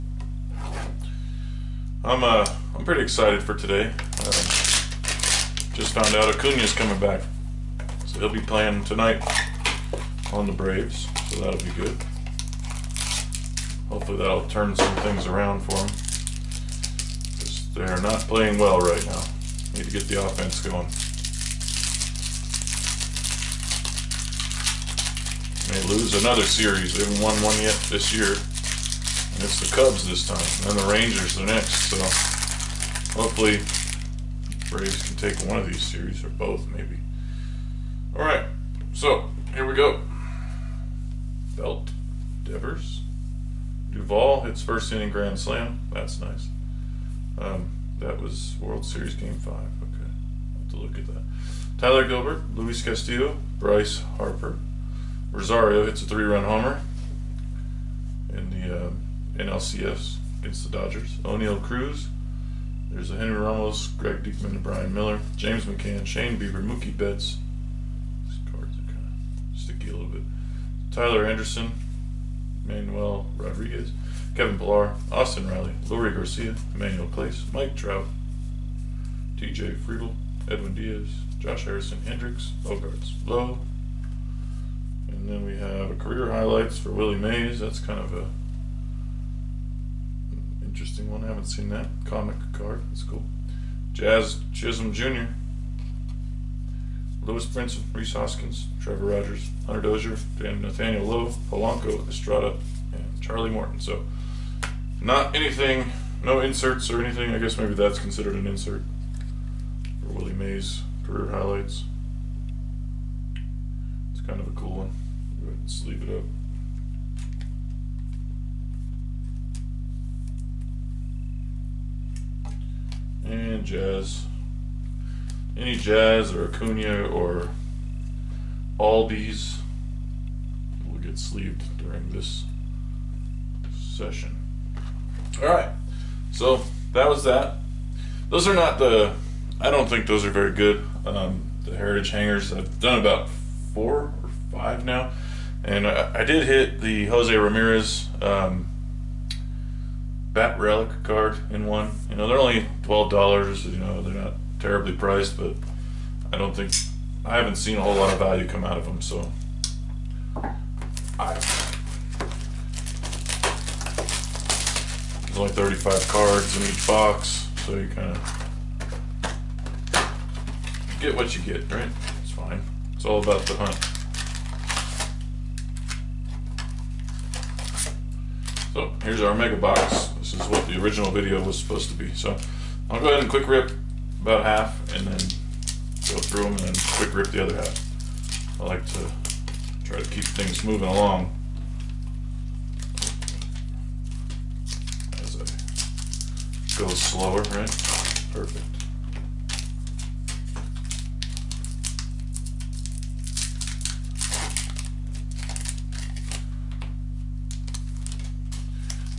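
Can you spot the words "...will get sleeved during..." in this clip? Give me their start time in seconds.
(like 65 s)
130 s.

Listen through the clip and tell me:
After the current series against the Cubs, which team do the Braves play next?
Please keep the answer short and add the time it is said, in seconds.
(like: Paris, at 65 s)
Rangers, at 30 s.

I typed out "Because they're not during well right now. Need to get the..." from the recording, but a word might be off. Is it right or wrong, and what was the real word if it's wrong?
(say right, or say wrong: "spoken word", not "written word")
wrong: "playing", not "during".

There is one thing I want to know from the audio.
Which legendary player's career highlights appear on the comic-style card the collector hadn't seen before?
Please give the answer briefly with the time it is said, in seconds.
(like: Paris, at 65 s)
Willie Mays, at 86 s.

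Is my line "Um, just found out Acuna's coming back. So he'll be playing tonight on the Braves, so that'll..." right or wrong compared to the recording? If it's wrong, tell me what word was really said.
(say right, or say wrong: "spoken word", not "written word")
right.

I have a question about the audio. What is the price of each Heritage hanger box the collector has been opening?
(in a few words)
$12.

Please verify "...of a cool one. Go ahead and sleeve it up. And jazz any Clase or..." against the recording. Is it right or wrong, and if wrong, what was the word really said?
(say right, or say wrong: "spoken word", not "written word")
wrong: "Jazz", not "Clase".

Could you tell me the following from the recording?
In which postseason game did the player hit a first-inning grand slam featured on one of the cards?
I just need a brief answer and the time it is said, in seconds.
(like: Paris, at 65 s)
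World Series Game 5, at 48 s.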